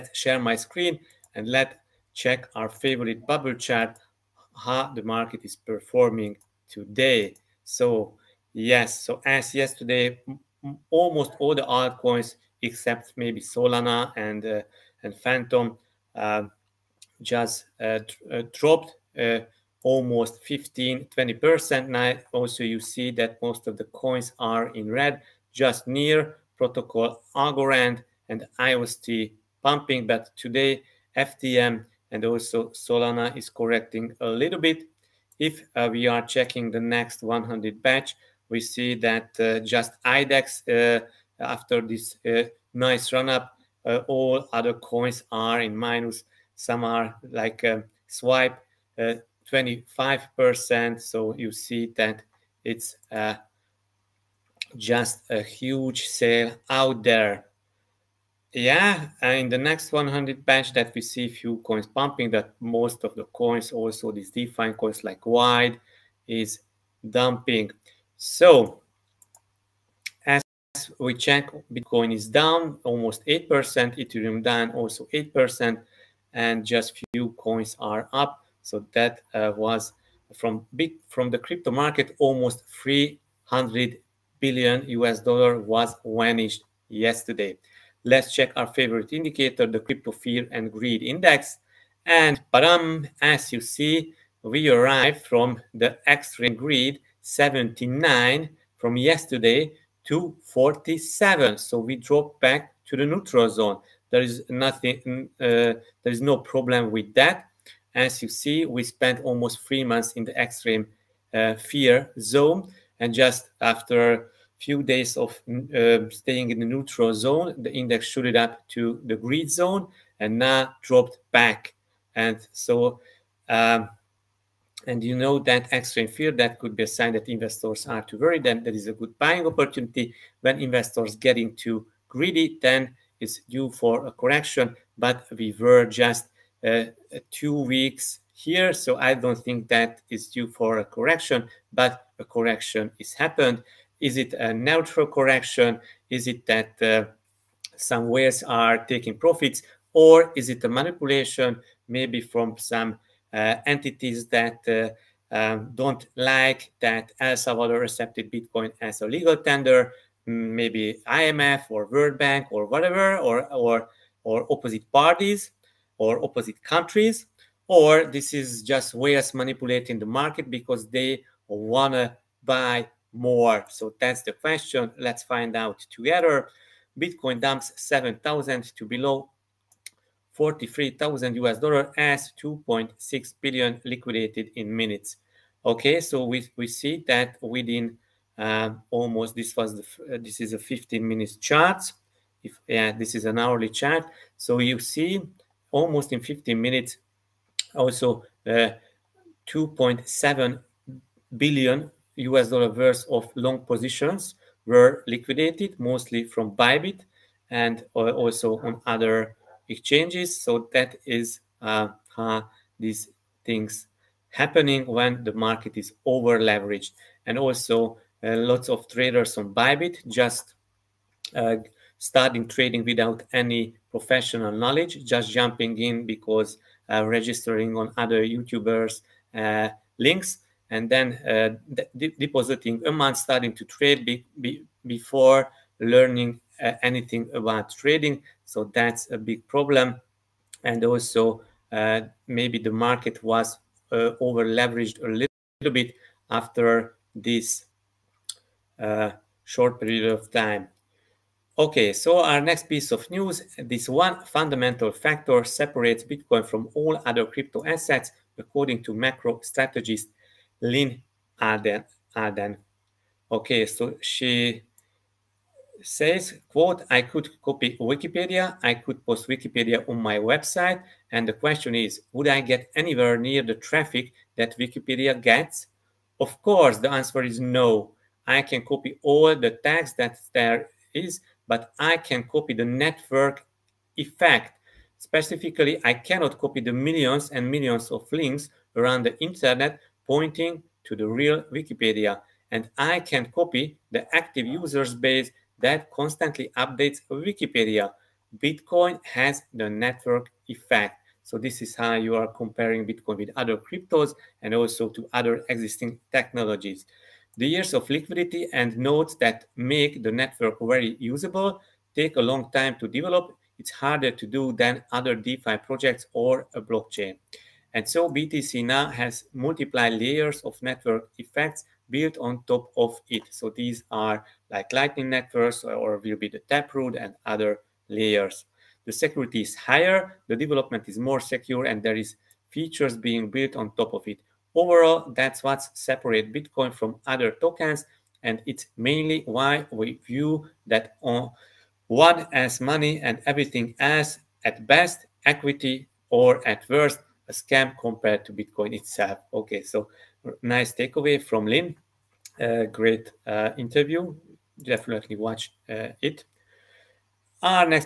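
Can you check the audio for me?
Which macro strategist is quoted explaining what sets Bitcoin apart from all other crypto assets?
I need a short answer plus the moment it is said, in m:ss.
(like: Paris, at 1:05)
Lyn Alden, at 4:20.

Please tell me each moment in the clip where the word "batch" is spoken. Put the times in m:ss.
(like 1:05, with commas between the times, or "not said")
0:37, 1:00.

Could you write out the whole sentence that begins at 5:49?
Okay, so nice takeaway from Lyn.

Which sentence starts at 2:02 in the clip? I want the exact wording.
And so, um, and you know that extreme fear, that could be a sign that investors are too worried.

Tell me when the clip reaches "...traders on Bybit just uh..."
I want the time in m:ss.
3:38.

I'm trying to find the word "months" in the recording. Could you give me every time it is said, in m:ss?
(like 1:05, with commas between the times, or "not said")
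1:49, 3:52.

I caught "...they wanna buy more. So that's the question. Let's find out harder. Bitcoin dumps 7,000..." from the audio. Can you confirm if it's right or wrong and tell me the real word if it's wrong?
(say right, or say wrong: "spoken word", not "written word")
wrong: "together", not "harder".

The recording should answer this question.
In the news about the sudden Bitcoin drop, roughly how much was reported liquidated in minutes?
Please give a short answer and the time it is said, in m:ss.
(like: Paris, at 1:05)
2.6 billion, at 3:02.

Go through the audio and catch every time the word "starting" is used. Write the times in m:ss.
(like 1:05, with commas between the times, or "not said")
3:41, 3:53.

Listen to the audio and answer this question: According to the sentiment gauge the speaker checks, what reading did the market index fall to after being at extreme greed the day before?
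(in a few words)
47.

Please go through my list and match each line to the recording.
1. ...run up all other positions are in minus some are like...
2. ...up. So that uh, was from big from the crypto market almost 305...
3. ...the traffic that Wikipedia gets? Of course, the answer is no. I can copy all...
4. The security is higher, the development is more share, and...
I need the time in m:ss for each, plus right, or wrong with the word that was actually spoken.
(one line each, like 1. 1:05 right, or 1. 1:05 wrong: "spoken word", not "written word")
1. 0:43 wrong: "coins", not "positions"
2. 1:18 wrong: "300", not "305"
3. 4:33 right
4. 5:28 wrong: "secure", not "share".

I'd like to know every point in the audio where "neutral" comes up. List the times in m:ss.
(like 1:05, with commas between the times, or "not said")
1:43, 1:56, 2:24.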